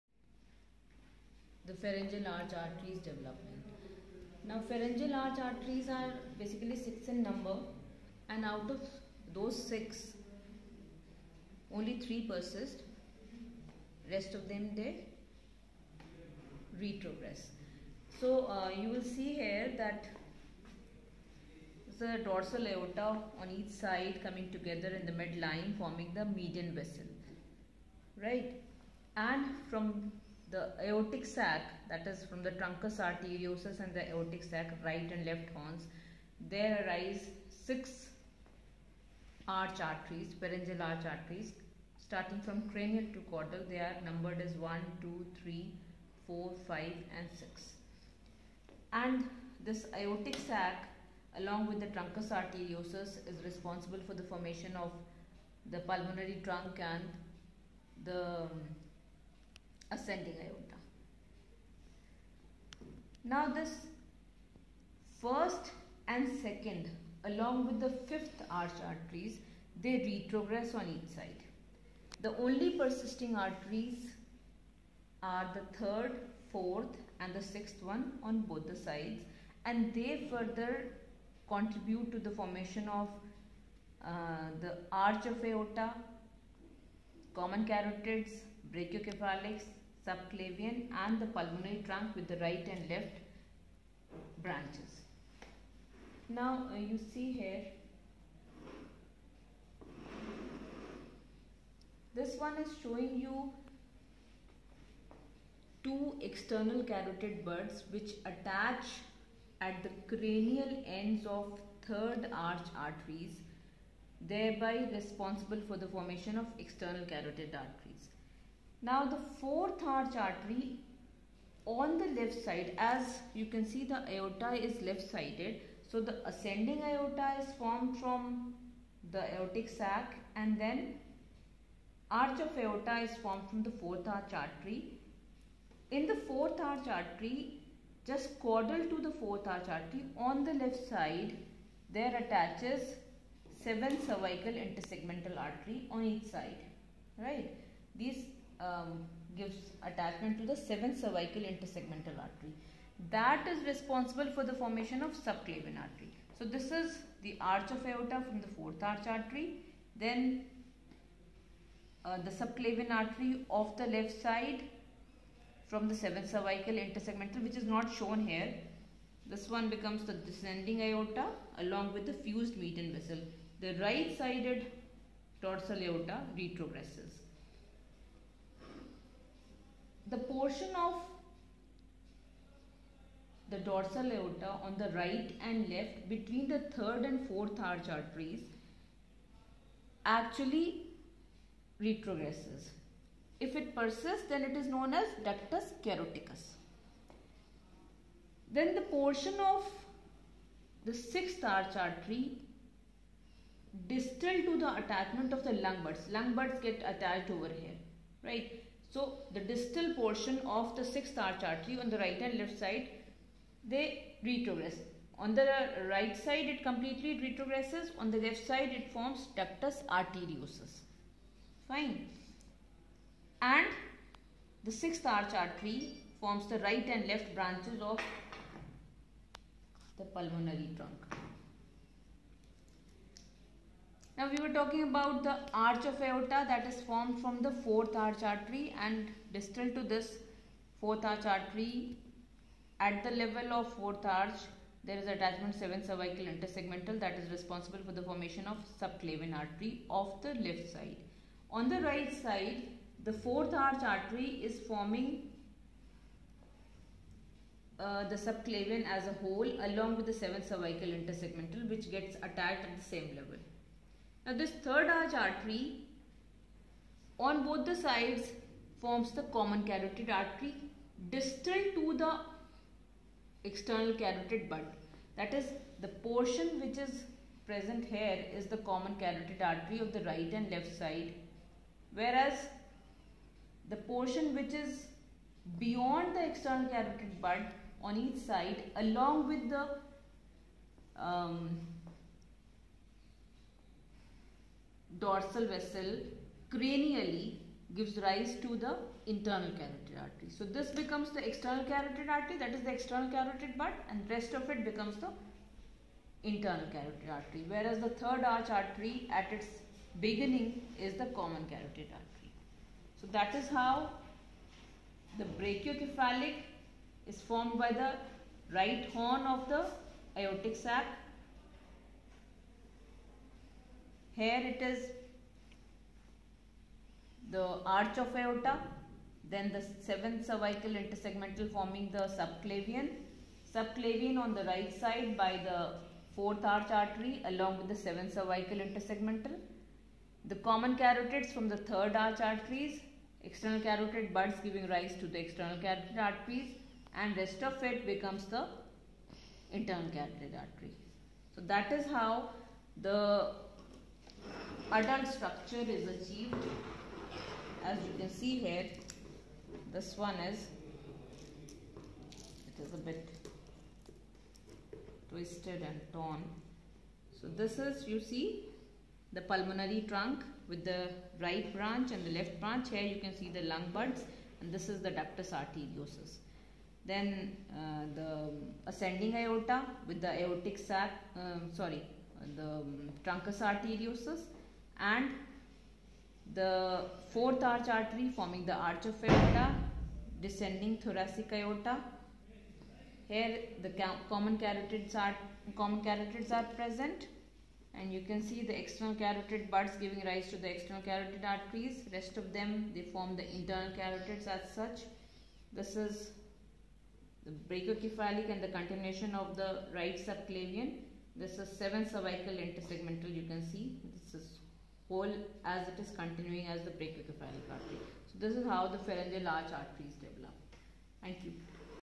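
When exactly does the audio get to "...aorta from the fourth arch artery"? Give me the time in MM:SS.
02:37.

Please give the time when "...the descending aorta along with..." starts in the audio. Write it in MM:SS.
02:50.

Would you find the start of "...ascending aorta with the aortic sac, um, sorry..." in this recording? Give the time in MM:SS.
06:18.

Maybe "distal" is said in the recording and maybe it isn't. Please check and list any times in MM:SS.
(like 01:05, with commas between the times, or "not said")
03:23, 03:29, 03:59, 04:31.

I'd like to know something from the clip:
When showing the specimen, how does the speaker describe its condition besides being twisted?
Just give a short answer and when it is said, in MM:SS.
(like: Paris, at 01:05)
Torn, at 06:05.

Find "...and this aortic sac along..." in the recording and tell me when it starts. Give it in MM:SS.
00:49.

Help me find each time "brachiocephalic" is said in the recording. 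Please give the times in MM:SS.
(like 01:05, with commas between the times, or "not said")
01:28, 05:15, 06:47, 06:56.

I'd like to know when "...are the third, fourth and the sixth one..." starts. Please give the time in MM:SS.
01:15.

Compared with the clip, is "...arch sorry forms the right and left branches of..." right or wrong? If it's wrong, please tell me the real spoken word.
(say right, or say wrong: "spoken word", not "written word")
wrong: "artery", not "sorry".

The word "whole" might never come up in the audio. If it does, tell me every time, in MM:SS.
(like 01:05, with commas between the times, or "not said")
04:19, 06:54.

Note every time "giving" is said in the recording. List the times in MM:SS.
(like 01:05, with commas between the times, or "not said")
05:44, 06:39.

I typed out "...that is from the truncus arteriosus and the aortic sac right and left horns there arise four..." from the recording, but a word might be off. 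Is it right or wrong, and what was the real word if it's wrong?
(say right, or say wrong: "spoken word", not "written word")
wrong: "six", not "four".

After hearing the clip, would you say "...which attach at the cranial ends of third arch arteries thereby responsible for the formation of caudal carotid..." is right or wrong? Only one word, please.
wrong.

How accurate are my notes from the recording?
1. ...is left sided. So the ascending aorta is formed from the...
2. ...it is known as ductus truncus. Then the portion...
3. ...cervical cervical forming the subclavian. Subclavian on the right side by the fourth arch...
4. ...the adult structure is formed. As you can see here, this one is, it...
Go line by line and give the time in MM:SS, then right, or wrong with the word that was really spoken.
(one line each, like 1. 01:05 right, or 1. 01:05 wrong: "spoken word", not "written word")
1. 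02:04 right
2. 03:14 wrong: "caroticus", not "truncus"
3. 05:30 wrong: "intersegmental", not "cervical"
4. 05:52 wrong: "achieved", not "formed".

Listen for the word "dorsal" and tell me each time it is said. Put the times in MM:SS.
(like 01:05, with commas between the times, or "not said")
00:22, 02:55, 03:03, 04:55.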